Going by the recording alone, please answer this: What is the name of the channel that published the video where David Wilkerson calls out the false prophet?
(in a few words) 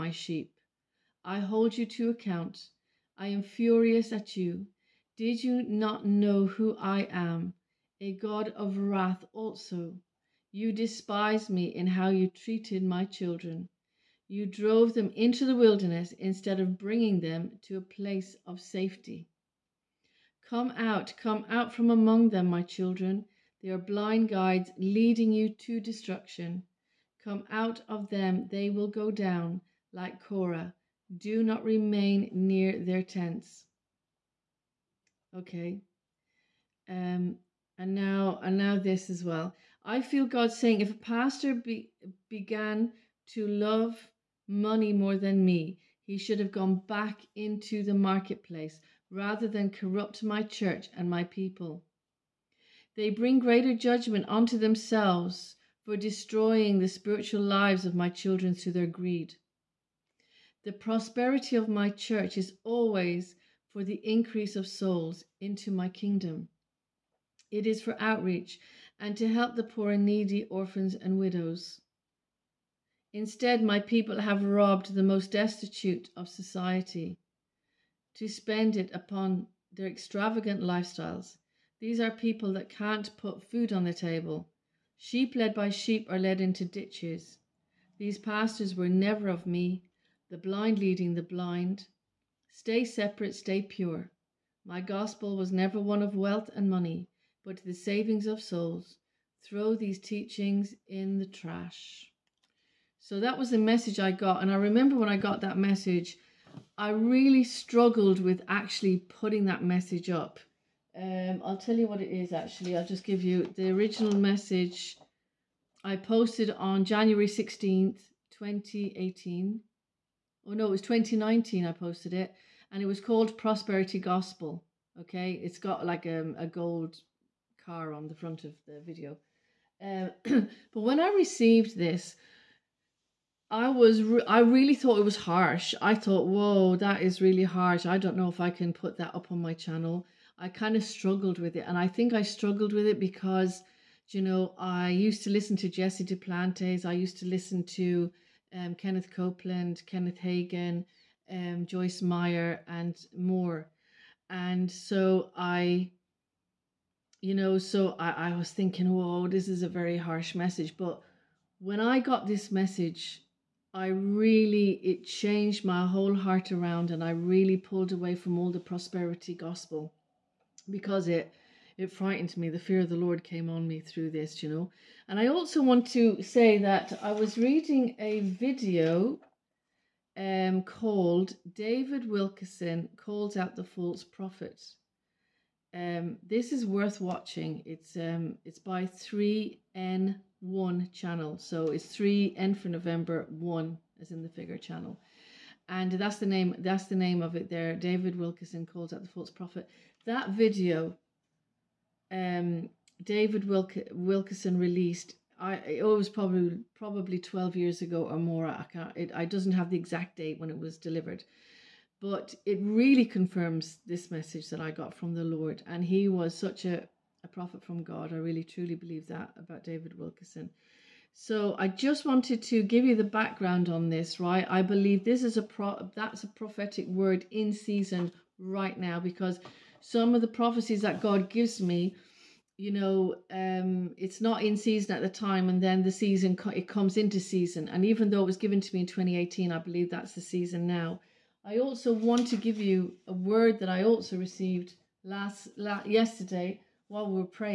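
3N1.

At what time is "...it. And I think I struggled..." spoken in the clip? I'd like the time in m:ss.
2:21.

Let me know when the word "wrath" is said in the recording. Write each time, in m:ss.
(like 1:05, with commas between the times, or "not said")
0:08.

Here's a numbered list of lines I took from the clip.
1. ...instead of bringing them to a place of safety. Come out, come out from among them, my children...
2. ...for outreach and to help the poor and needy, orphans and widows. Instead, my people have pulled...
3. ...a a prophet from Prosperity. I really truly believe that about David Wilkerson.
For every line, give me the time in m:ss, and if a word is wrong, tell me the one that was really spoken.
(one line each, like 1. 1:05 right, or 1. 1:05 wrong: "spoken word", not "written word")
1. 0:16 right
2. 1:07 wrong: "robbed", not "pulled"
3. 3:36 wrong: "God", not "Prosperity".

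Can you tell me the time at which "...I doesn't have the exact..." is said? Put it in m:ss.
3:29.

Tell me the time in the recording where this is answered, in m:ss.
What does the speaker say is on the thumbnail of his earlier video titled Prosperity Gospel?
2:06.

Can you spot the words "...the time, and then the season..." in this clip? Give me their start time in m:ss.
3:55.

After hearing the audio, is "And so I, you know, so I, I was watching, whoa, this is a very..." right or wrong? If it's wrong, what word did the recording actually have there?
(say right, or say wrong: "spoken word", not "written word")
wrong: "thinking", not "watching".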